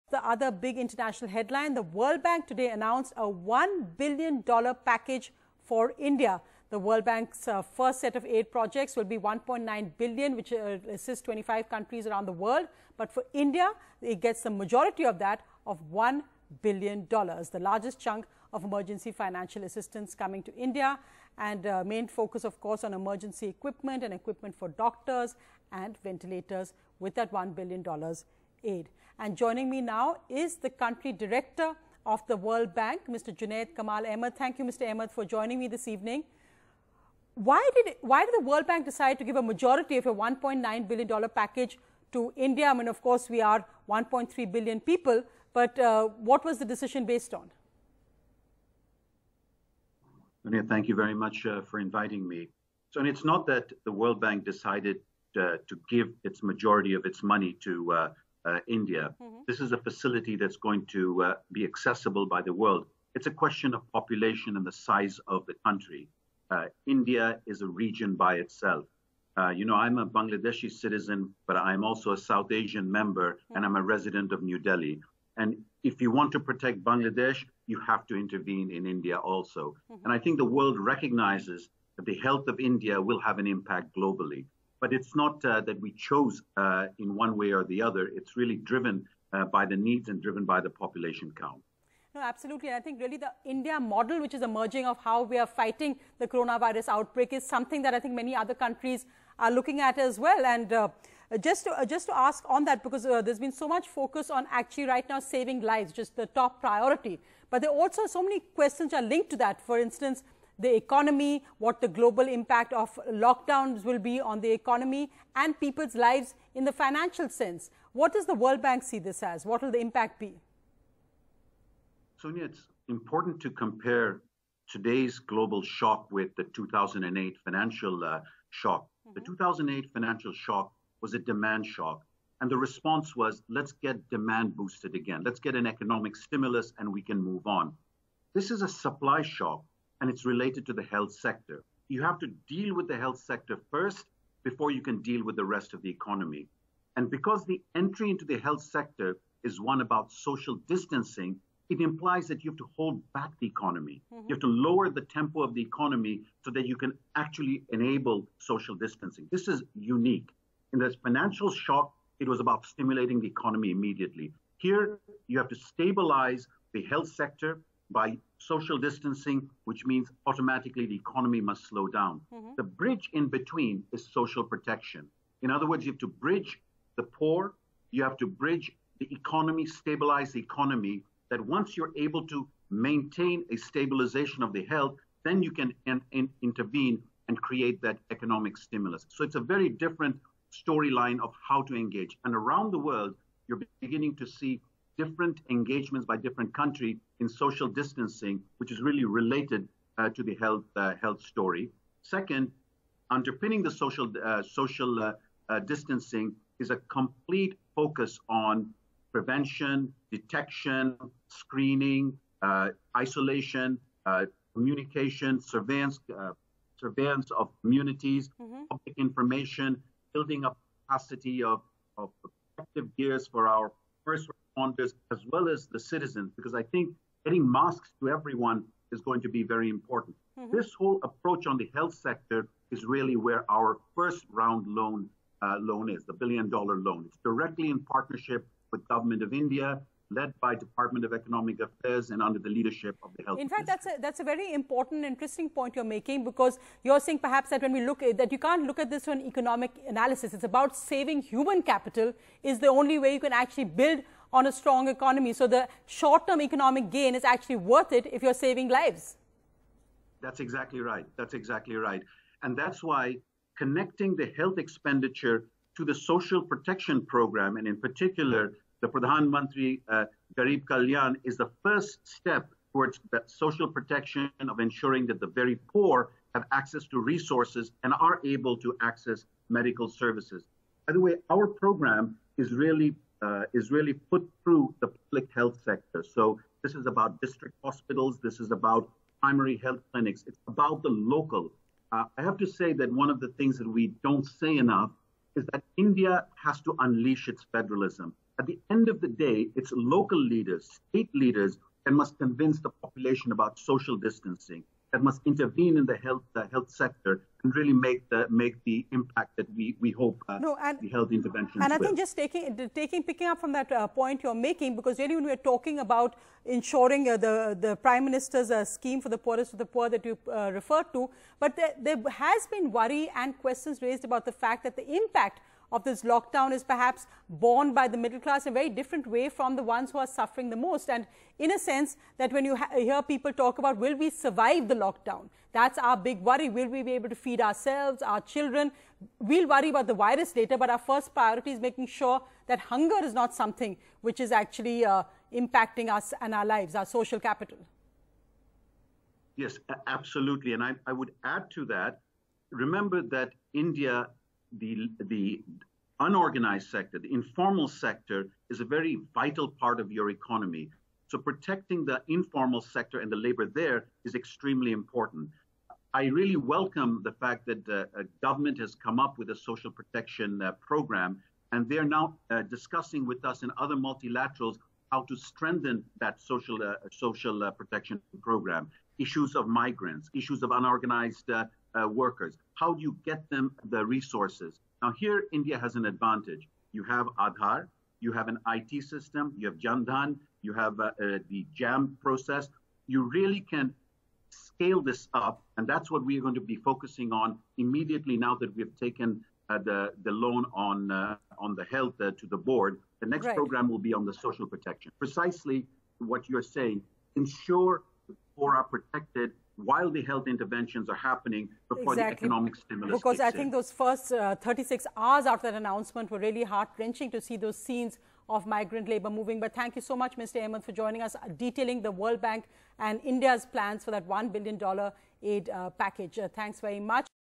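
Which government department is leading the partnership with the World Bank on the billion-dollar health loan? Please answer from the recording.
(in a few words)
Department of Economic Affairs.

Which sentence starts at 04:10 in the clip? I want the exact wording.
It's about saving human capital is the only way you can actually build on a strong economy.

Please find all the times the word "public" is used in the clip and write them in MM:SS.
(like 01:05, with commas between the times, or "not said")
03:38, 04:44.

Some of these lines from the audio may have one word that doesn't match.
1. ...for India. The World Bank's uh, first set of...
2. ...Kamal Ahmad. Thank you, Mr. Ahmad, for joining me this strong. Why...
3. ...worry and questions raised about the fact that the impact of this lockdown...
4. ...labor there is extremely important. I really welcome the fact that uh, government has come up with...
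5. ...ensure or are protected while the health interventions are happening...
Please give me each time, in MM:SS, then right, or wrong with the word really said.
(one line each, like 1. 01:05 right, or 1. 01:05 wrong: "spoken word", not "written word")
1. 00:05 right
2. 00:33 wrong: "evening", not "strong"
3. 05:22 right
4. 06:03 right
5. 06:47 right.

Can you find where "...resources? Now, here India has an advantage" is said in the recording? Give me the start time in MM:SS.
06:23.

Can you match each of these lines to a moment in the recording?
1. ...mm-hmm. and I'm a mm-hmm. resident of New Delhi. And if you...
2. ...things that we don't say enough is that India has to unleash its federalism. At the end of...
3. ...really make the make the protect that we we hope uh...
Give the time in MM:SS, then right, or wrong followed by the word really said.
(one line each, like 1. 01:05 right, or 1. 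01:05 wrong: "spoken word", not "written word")
1. 01:13 right
2. 04:53 right
3. 05:07 wrong: "impact", not "protect".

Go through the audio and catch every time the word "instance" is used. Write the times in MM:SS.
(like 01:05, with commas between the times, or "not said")
01:49.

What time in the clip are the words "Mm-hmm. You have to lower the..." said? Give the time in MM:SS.
02:34.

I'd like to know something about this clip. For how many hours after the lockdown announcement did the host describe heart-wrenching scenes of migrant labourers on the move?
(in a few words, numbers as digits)
36.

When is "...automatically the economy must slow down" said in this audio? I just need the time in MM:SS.
02:50.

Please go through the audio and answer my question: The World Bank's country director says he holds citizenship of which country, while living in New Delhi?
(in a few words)
Bangladesh.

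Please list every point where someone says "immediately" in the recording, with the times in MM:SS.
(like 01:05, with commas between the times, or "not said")
02:43, 06:37.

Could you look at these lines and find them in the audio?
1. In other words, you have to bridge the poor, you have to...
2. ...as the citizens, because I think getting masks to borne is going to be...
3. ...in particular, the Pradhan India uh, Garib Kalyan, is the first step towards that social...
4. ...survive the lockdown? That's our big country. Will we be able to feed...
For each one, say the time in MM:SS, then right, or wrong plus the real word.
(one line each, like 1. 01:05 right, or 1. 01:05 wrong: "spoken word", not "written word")
1. 02:55 right
2. 03:45 wrong: "everyone", not "borne"
3. 04:27 wrong: "Mantri", not "India"
4. 05:34 wrong: "worry", not "country".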